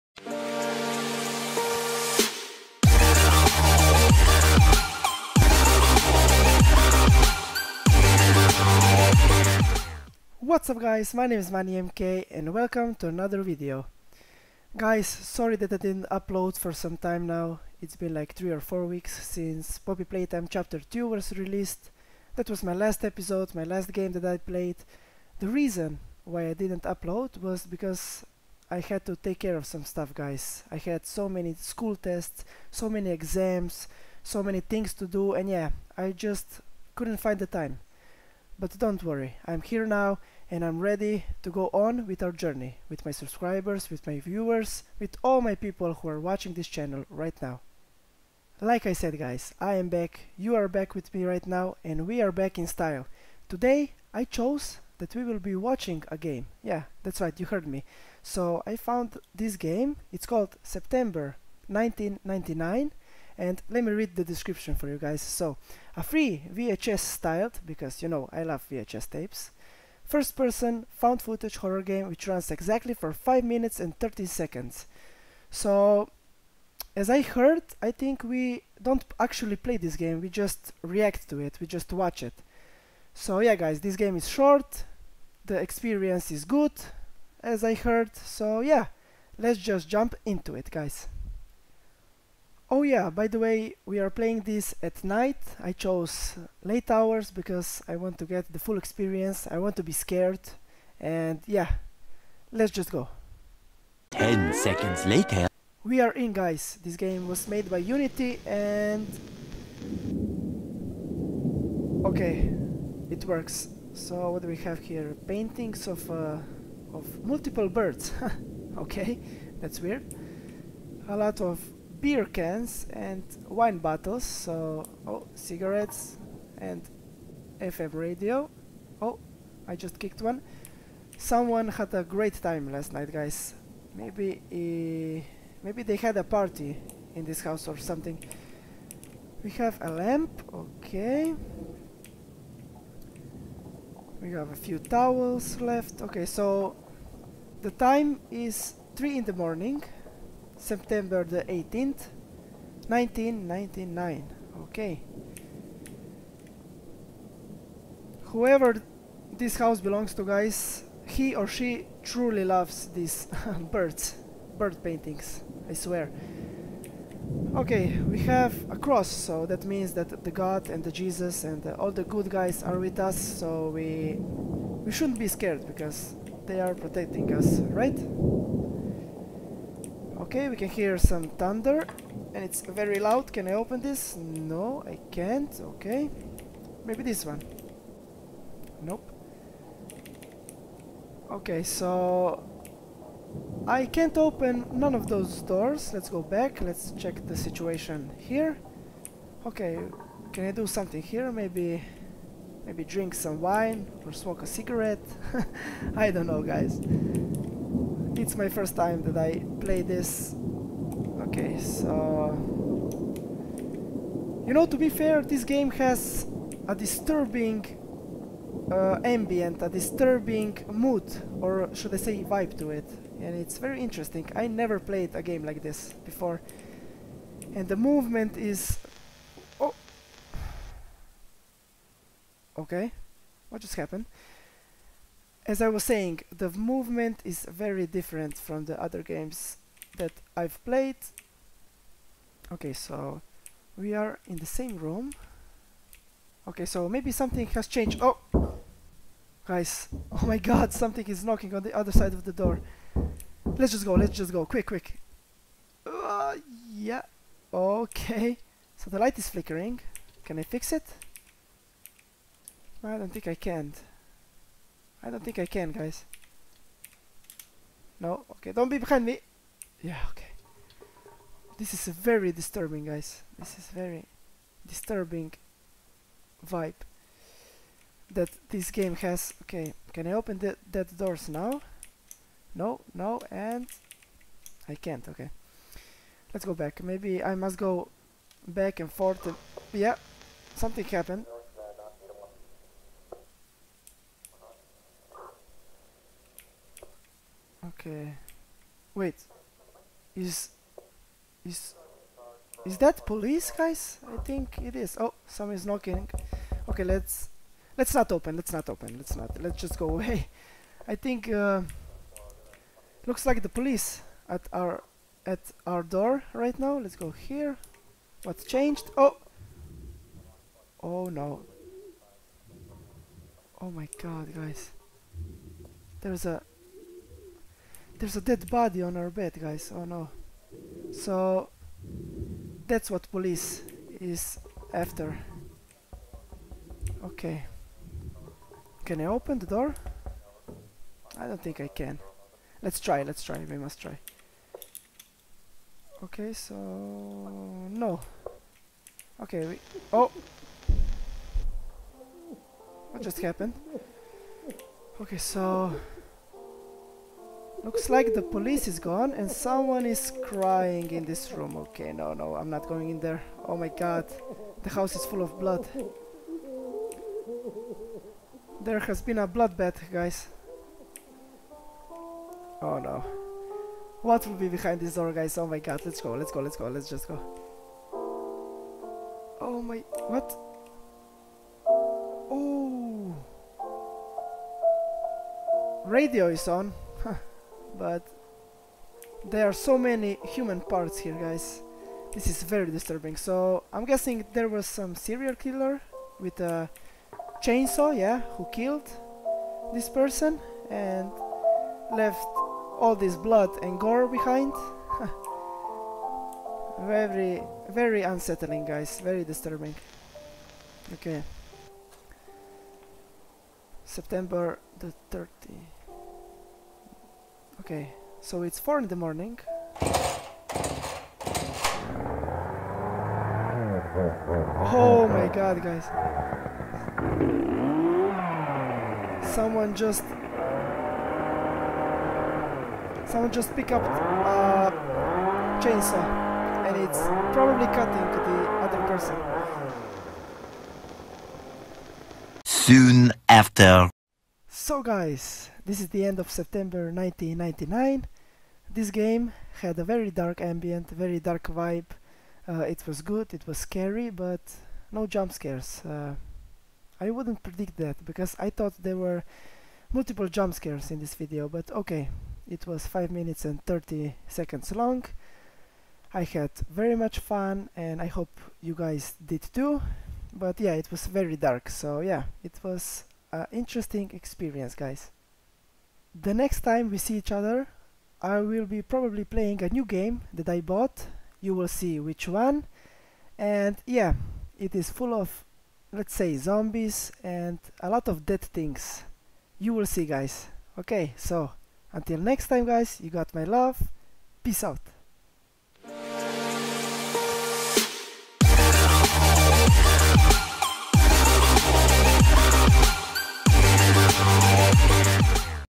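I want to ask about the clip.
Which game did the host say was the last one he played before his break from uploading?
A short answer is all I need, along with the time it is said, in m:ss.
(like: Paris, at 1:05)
Poppy Playtime Chapter 2, at 0:19.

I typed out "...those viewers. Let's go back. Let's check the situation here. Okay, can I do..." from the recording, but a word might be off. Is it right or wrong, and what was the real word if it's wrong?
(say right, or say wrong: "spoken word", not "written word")
wrong: "doors", not "viewers".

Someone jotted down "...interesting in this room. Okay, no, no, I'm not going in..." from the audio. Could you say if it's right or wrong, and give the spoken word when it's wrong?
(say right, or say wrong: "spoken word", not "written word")
wrong: "crying", not "interesting".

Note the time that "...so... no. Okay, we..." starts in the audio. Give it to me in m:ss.
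5:46.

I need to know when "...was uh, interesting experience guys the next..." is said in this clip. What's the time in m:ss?
7:52.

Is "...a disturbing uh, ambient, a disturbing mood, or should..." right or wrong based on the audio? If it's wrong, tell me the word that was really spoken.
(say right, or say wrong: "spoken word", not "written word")
right.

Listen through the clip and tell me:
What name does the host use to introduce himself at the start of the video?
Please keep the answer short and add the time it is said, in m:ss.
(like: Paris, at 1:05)
MK, at 0:11.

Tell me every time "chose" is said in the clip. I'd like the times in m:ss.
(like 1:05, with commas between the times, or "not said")
0:54, 1:35.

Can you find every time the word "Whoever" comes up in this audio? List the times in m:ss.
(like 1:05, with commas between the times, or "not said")
2:38.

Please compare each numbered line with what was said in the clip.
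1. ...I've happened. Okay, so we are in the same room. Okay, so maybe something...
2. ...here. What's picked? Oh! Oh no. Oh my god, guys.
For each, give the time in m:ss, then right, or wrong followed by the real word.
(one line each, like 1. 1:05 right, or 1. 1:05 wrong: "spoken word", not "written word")
1. 4:00 wrong: "played", not "happened"
2. 5:17 wrong: "changed", not "picked".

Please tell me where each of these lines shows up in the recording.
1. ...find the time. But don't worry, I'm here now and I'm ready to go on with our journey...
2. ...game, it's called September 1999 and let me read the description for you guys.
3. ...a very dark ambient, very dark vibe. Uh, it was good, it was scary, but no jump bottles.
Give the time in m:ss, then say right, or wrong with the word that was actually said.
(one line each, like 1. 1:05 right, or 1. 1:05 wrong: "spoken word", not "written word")
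1. 0:37 right
2. 0:59 right
3. 7:29 wrong: "scares", not "bottles".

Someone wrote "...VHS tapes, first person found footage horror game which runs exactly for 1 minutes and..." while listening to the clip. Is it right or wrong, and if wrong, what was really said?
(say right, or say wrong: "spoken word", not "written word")
wrong: "5", not "1".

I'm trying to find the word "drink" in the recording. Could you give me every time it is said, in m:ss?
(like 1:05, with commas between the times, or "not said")
3:22.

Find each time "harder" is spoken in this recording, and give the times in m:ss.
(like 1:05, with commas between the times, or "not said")
not said.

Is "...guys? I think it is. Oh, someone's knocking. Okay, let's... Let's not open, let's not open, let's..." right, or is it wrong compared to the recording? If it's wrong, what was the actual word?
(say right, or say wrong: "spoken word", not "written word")
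right.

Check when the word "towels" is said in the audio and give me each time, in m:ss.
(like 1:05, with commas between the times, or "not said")
2:24.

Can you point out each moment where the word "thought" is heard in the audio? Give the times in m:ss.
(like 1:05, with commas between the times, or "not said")
7:38.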